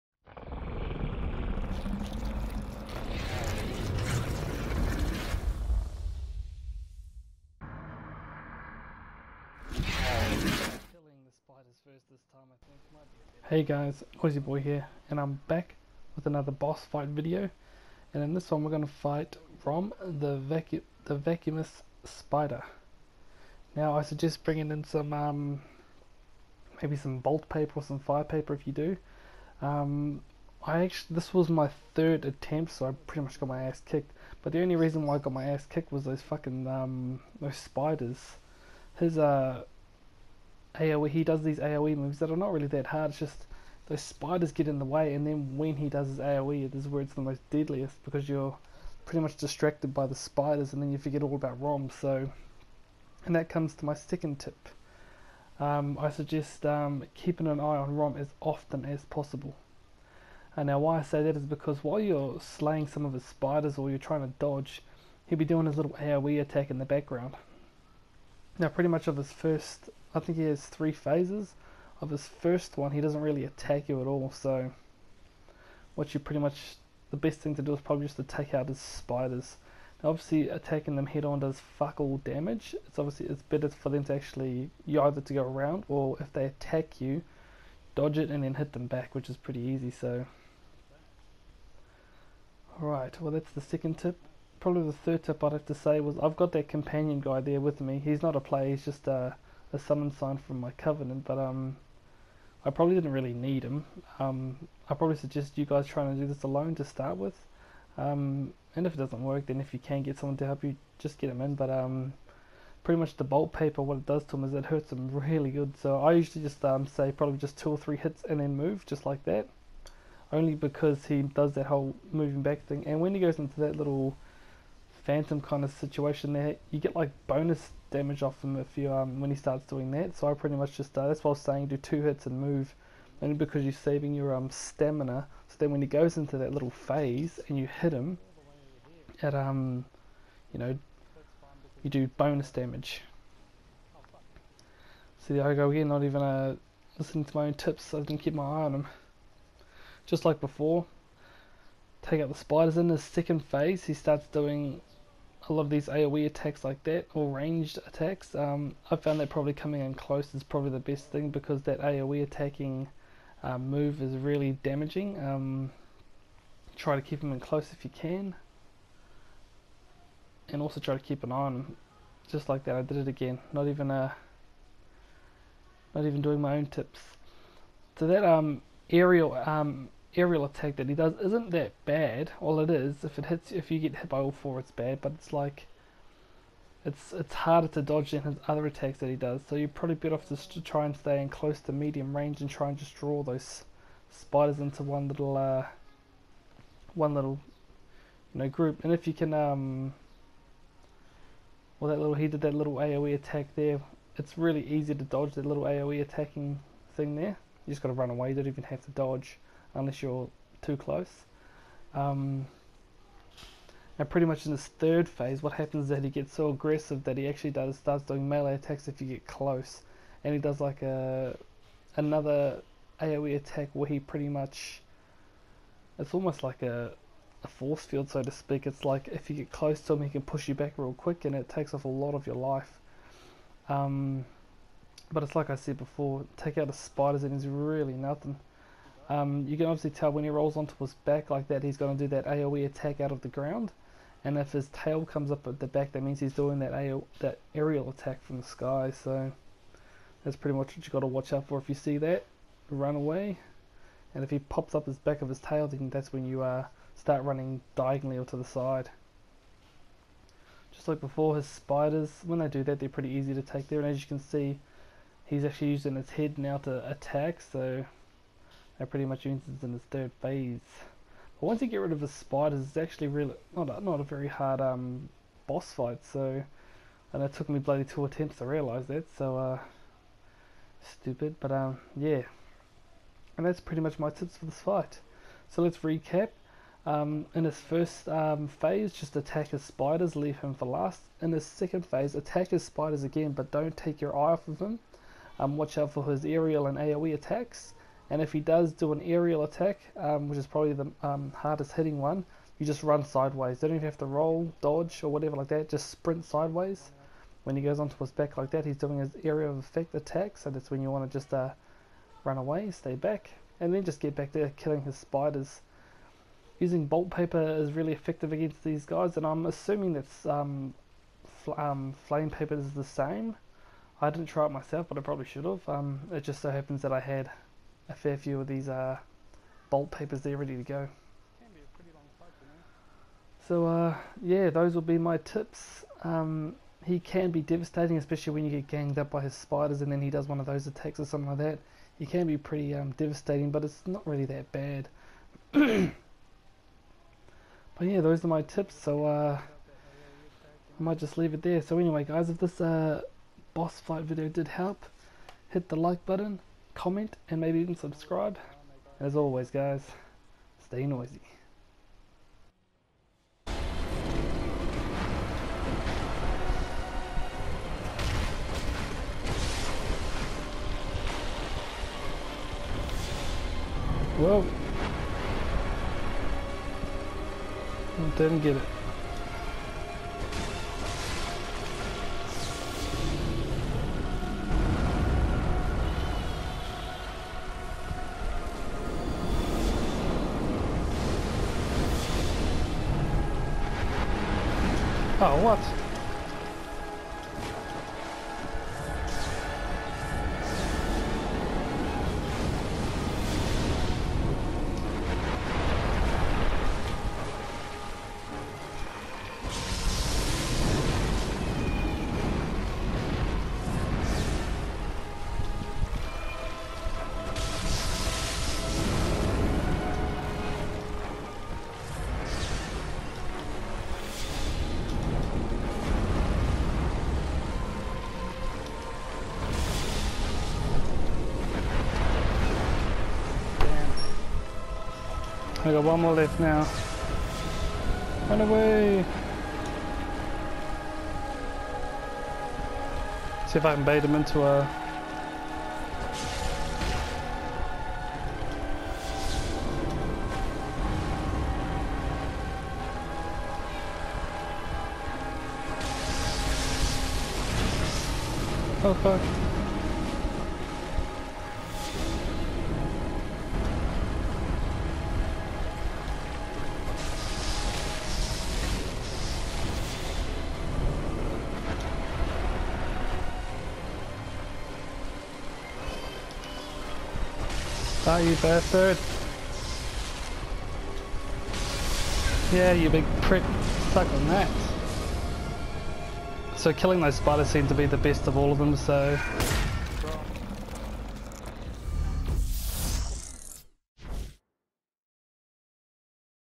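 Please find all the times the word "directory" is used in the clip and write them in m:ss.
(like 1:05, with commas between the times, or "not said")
not said.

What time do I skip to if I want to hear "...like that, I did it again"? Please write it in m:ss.
2:52.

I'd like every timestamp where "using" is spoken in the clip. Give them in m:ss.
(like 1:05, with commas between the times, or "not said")
4:25, 5:16.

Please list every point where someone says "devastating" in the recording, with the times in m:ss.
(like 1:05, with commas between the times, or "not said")
5:37, 5:42.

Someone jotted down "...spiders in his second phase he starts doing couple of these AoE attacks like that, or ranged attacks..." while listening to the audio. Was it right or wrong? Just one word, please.
right.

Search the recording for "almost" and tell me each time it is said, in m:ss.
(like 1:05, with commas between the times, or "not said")
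3:46.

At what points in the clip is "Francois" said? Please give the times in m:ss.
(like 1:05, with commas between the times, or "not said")
not said.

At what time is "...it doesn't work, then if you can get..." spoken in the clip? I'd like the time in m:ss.
1:48.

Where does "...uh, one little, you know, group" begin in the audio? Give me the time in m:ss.
3:15.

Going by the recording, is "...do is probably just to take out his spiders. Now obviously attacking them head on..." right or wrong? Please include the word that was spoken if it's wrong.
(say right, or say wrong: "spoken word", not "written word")
right.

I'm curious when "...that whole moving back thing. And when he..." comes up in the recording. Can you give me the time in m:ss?
2:01.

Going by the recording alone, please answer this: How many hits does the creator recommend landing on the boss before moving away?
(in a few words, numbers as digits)
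2 or 3.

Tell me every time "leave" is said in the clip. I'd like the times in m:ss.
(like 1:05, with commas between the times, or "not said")
4:50, 5:51.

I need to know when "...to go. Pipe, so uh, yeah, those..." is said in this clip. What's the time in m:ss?
5:30.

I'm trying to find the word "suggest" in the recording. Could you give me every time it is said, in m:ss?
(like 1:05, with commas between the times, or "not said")
0:24, 0:56, 1:45.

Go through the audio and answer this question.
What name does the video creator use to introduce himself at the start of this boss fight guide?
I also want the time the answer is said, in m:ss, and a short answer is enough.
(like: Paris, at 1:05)
NoisiBoi, at 0:14.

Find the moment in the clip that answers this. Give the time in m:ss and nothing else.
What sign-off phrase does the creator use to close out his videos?
6:00.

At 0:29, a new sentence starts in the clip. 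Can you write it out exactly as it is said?
Um, I actually, this was my third attempt, so I pretty much got my ass kicked.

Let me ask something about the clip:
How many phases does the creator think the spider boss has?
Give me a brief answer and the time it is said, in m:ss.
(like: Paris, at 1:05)
3, at 1:10.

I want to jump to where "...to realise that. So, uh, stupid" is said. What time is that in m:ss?
4:38.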